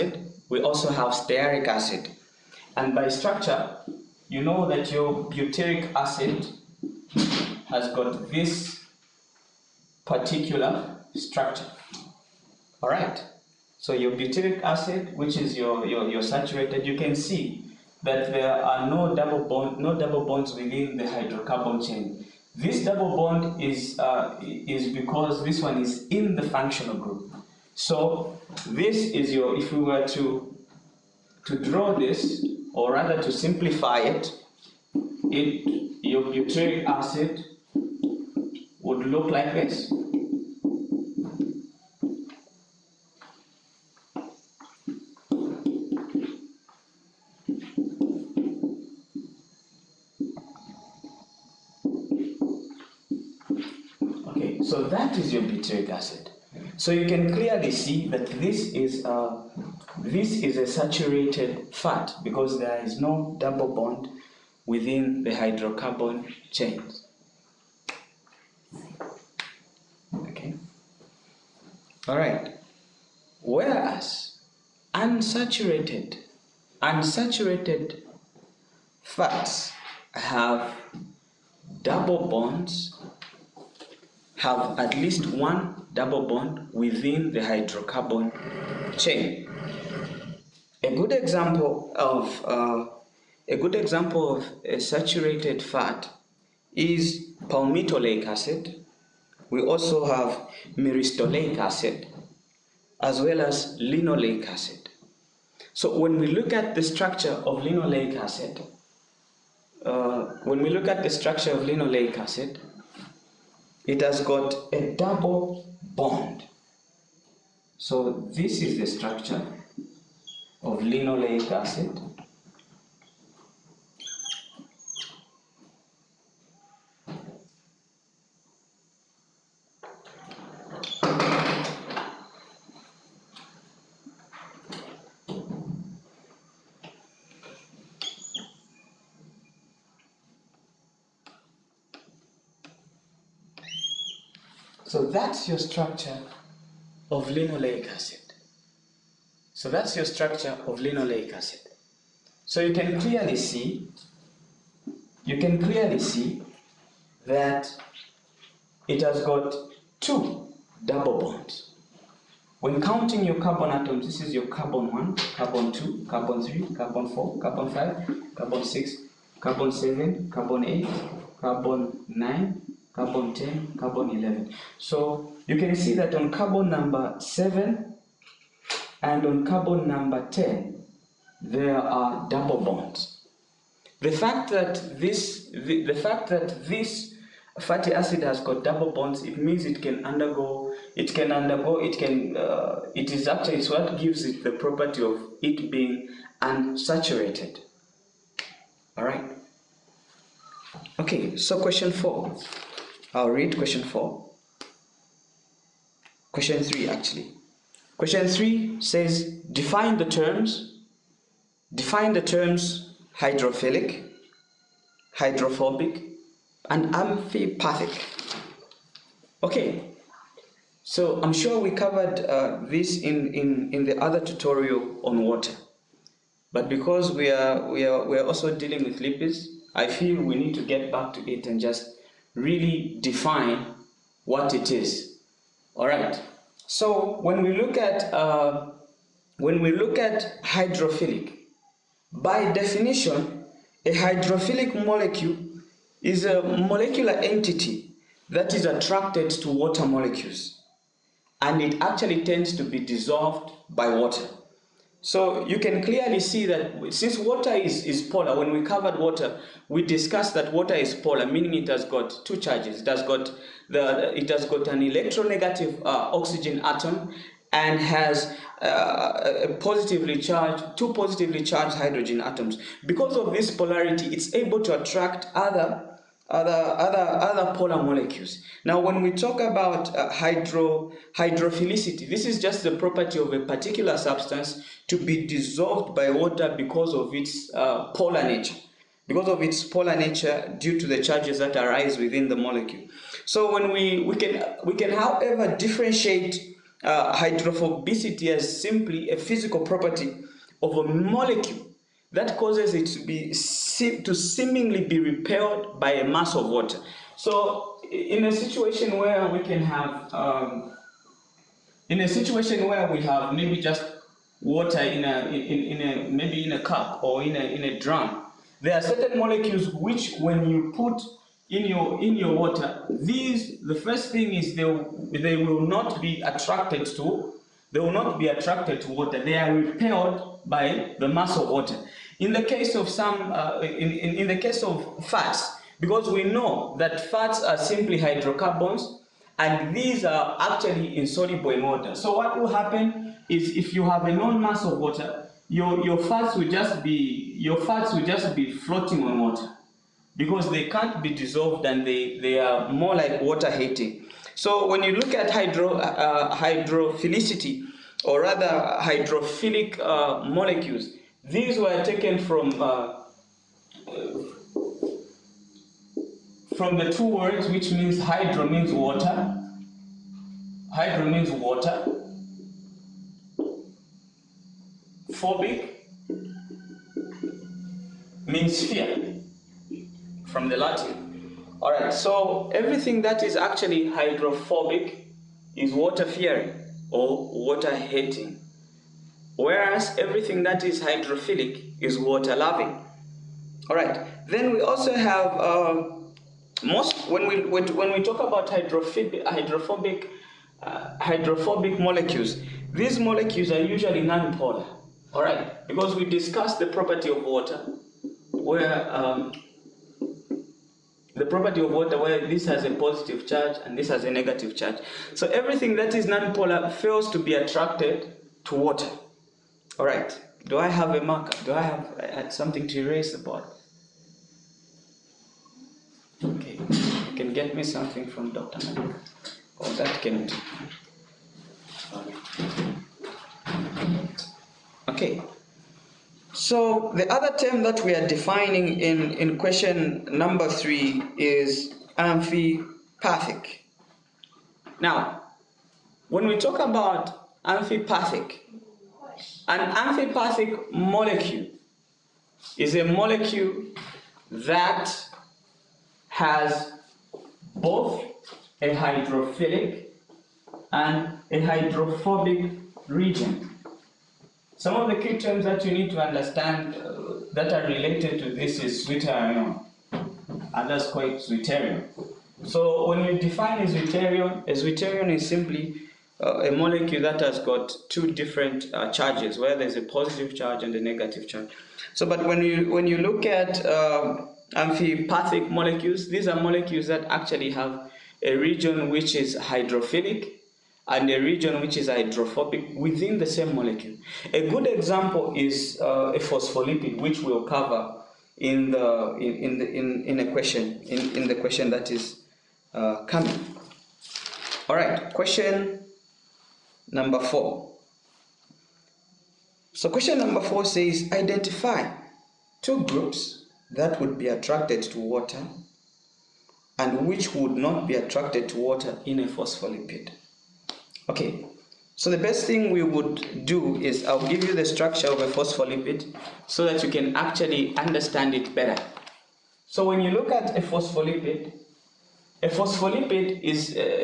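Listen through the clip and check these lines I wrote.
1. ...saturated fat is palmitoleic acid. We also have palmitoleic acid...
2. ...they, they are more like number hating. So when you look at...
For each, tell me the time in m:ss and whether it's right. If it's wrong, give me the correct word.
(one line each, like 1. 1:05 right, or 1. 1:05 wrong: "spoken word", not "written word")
1. 1:34 wrong: "myristoleic", not "palmitoleic"
2. 5:51 wrong: "water", not "number".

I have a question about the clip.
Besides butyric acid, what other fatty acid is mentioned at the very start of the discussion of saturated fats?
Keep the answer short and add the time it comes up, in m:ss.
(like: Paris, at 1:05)
stearic acid, at 0:01.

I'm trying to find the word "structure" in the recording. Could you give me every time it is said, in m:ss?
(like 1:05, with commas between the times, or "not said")
0:03, 0:11, 1:46, 1:51, 1:58, 2:25, 2:30, 8:44.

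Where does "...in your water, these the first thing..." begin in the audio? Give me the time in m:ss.
5:22.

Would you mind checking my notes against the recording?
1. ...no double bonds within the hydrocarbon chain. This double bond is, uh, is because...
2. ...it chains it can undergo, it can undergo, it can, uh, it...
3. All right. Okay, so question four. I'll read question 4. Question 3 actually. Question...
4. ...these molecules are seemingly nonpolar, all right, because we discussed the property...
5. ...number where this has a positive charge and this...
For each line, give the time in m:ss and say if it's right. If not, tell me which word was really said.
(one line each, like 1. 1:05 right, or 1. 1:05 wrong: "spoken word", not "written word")
1. 0:19 right
2. 3:09 wrong: "means", not "chains"
3. 3:18 right
4. 6:42 wrong: "usually", not "seemingly"
5. 6:51 wrong: "water", not "number".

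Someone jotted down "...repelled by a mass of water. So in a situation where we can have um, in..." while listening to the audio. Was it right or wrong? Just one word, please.
right.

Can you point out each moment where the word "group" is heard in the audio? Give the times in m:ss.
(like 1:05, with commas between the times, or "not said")
0:26, 8:32.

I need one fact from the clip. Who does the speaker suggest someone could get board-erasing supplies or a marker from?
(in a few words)
Dr. Manik.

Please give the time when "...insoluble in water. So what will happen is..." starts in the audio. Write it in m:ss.
5:40.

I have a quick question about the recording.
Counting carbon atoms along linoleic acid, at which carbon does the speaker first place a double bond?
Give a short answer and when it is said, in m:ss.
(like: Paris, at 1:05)
7, at 2:56.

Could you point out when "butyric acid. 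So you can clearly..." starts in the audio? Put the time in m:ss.
0:55.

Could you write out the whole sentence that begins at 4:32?
Because of this polarity, it's able to attract other other, other, other polar molecules.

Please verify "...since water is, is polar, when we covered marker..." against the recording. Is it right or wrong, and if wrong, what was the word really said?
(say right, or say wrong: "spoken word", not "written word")
wrong: "water", not "marker".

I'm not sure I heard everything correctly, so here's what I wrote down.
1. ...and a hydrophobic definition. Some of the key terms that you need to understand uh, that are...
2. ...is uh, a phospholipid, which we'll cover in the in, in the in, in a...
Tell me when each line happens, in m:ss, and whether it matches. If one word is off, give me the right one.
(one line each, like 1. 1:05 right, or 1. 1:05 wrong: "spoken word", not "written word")
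1. 7:40 wrong: "region", not "definition"
2. 8:15 right.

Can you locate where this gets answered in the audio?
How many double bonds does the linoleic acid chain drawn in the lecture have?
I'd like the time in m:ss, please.
2:39.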